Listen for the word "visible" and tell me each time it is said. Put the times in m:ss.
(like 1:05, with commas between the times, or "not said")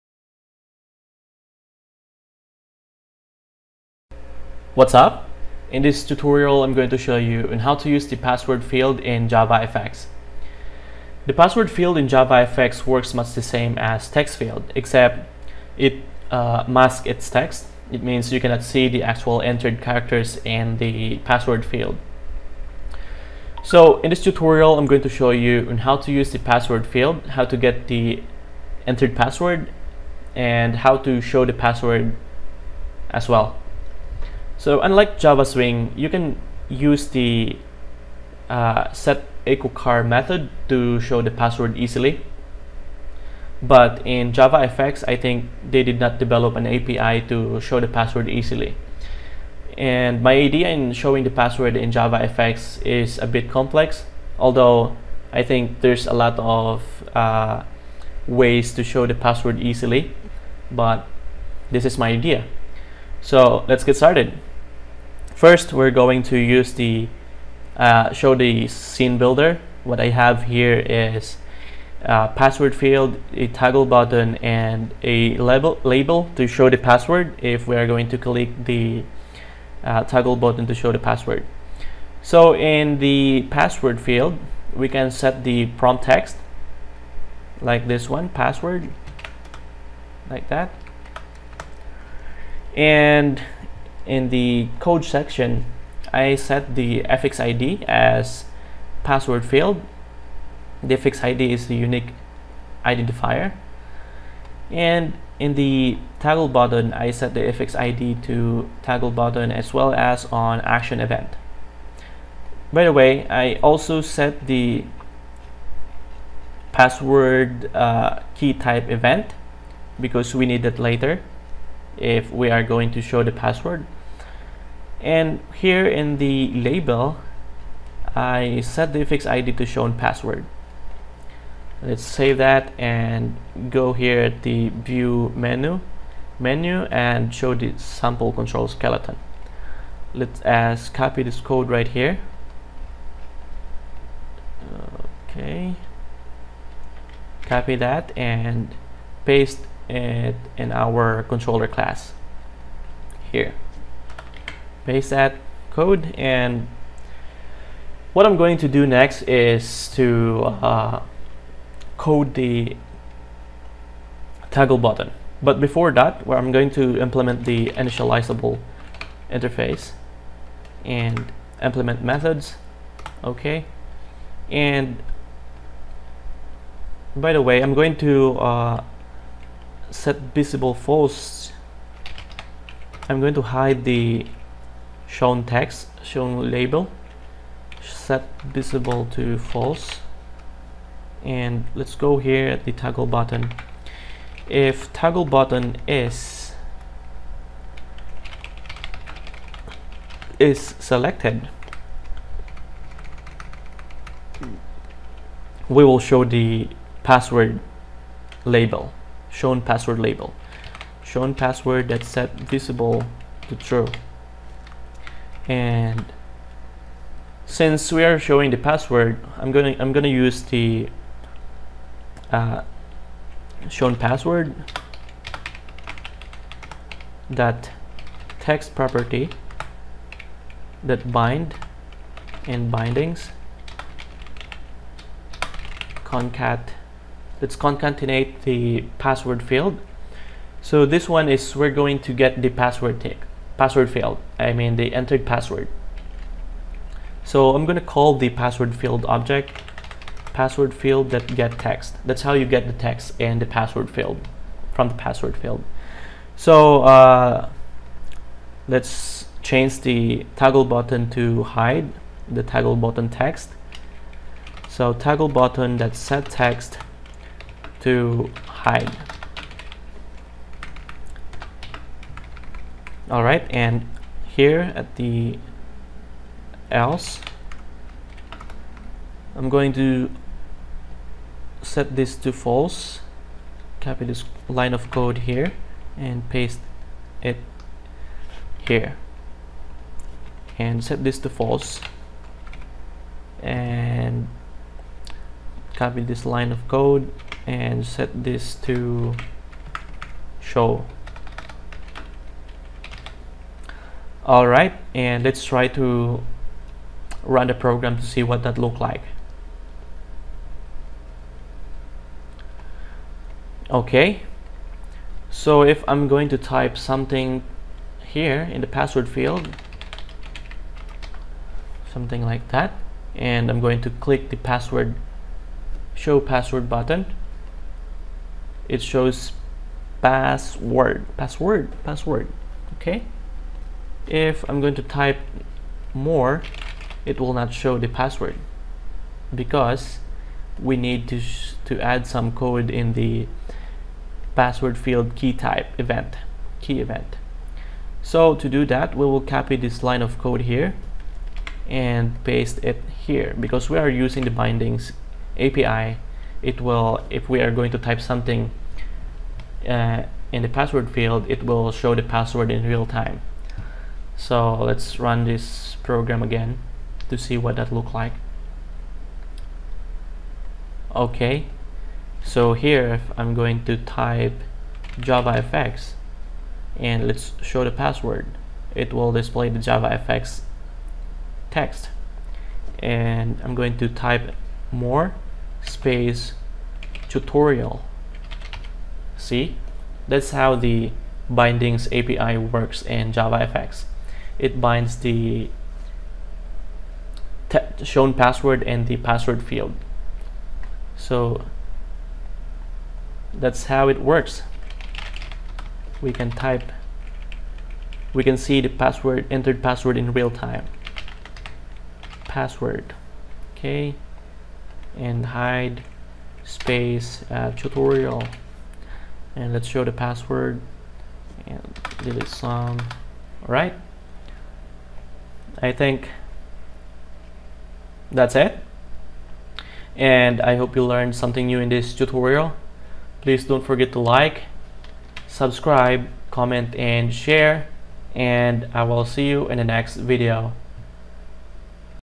3:00, 3:08, 3:32.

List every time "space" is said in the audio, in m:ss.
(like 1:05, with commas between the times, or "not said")
6:25, 6:56.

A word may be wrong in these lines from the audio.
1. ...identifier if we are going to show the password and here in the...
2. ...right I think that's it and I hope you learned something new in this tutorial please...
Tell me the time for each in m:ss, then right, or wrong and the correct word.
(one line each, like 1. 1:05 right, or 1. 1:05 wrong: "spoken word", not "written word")
1. 2:00 wrong: "later", not "identifier"
2. 7:03 right.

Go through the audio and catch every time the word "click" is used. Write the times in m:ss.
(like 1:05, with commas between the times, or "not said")
1:18, 5:23.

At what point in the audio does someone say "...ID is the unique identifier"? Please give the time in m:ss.
1:41.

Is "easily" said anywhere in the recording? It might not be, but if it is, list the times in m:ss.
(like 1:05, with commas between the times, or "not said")
0:41, 0:48, 0:59.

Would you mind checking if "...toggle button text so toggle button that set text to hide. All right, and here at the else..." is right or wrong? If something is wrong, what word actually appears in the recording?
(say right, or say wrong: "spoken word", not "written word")
right.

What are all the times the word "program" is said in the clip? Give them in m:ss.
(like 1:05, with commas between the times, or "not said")
5:07, 6:05.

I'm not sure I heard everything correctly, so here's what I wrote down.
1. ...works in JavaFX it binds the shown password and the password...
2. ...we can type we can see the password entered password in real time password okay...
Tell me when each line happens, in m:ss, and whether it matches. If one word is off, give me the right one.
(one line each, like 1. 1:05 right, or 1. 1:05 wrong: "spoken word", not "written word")
1. 6:32 right
2. 6:46 right.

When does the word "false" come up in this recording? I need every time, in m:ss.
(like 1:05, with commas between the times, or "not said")
3:00, 3:09, 4:42, 4:51.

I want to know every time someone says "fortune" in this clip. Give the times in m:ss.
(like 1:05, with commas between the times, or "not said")
not said.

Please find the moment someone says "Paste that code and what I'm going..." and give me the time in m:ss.
2:34.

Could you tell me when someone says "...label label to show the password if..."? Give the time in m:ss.
1:15.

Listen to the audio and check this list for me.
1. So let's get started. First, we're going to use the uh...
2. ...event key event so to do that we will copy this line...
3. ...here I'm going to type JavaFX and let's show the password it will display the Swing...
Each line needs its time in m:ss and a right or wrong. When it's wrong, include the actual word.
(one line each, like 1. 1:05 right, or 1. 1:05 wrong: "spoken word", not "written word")
1. 1:03 right
2. 5:45 right
3. 6:12 wrong: "JavaFX", not "Swing".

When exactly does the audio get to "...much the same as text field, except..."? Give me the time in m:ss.
0:13.